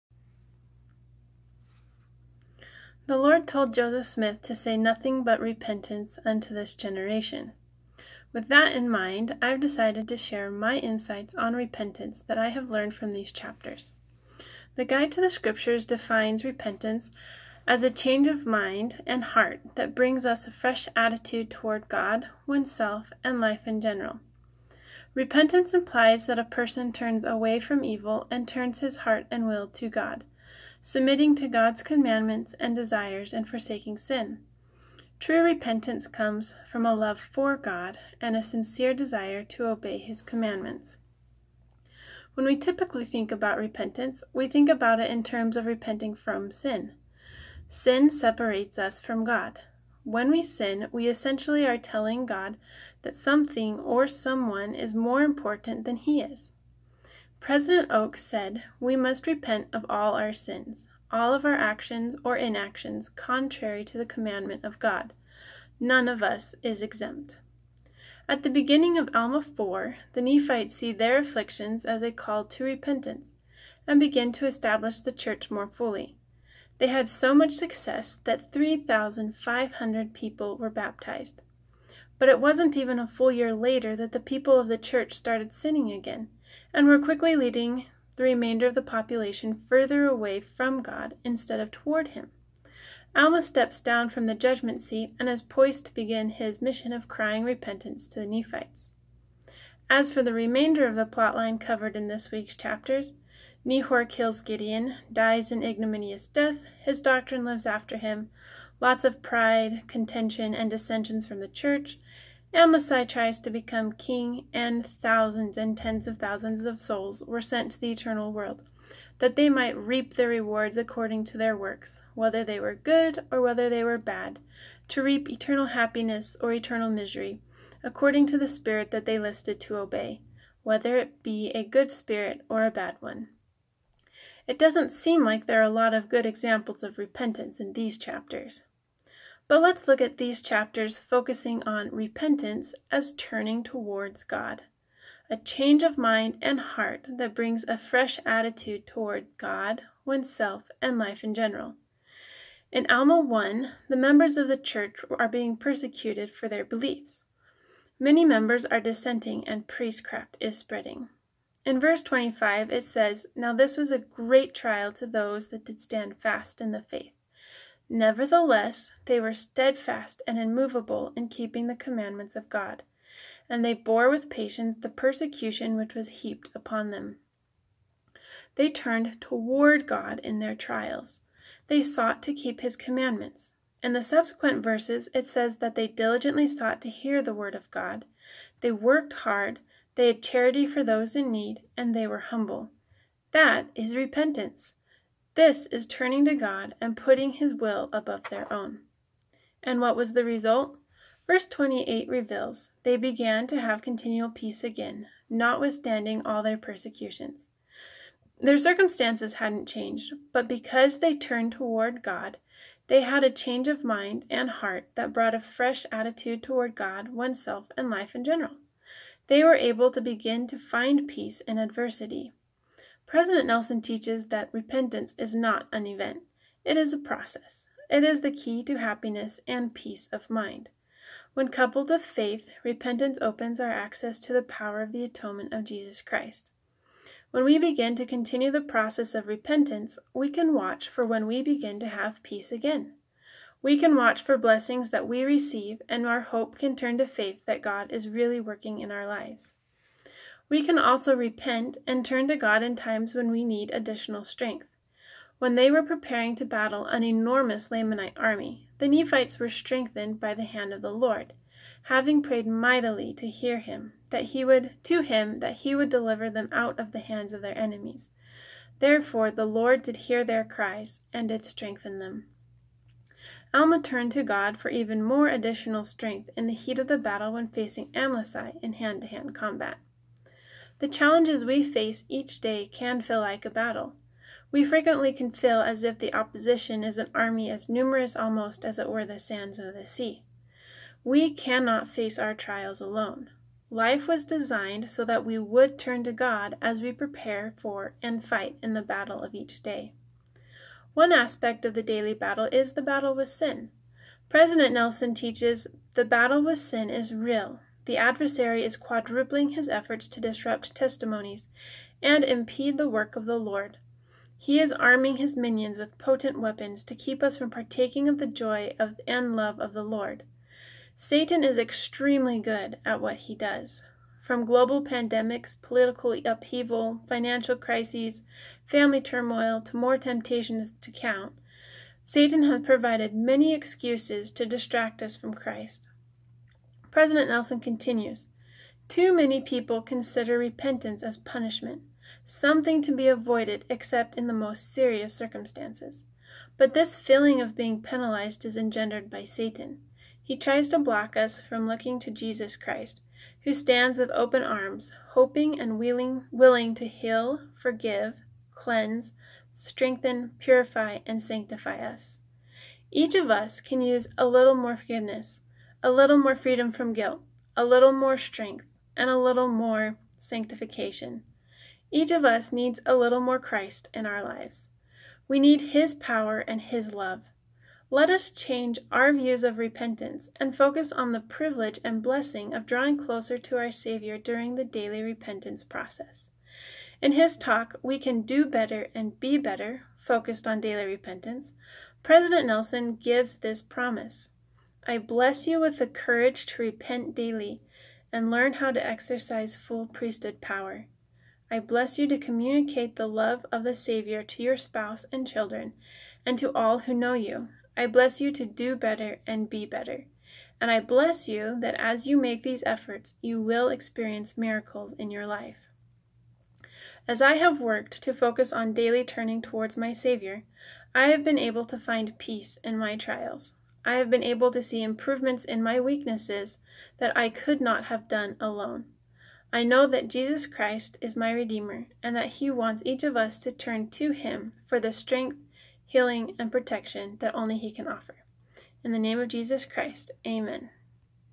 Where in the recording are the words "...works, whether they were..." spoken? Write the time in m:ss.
2:01.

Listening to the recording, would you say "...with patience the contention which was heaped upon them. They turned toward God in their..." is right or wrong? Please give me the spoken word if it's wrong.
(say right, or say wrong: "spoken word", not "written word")
wrong: "persecution", not "contention".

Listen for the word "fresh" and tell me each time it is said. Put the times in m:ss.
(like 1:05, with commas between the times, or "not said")
0:20, 2:27, 3:35.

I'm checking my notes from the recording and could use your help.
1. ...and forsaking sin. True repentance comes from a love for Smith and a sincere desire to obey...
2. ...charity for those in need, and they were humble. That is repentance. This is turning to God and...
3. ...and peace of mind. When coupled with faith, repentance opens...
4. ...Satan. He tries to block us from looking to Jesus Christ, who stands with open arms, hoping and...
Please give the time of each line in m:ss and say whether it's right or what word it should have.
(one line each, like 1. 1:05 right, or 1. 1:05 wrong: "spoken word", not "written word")
1. 0:33 wrong: "God", not "Smith"
2. 3:10 right
3. 3:49 right
4. 5:49 right.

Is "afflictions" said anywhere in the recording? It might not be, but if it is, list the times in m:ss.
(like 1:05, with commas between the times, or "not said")
1:11.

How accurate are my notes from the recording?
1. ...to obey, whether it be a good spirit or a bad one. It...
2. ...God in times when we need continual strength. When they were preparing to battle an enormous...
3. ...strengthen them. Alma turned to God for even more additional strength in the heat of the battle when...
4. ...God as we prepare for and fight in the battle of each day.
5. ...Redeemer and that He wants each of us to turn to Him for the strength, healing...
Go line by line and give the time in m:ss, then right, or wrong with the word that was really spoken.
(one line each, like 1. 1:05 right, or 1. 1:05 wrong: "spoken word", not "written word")
1. 2:09 right
2. 4:12 wrong: "additional", not "continual"
3. 4:31 right
4. 4:56 right
5. 7:11 right.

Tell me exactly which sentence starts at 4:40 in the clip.
The challenges we face each day can feel like a battle.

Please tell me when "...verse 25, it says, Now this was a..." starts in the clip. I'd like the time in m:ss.
2:41.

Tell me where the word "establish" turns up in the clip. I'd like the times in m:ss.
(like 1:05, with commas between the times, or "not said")
1:14.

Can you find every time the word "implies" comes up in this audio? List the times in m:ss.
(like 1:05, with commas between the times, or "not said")
0:25.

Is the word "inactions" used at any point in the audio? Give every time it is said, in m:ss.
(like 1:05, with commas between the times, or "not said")
1:02.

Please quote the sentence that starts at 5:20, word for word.
Satan is extremely good at what he does.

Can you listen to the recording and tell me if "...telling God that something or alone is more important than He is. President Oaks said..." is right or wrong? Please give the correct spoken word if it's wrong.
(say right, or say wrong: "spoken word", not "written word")
wrong: "someone", not "alone".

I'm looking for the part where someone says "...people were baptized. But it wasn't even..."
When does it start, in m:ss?
1:20.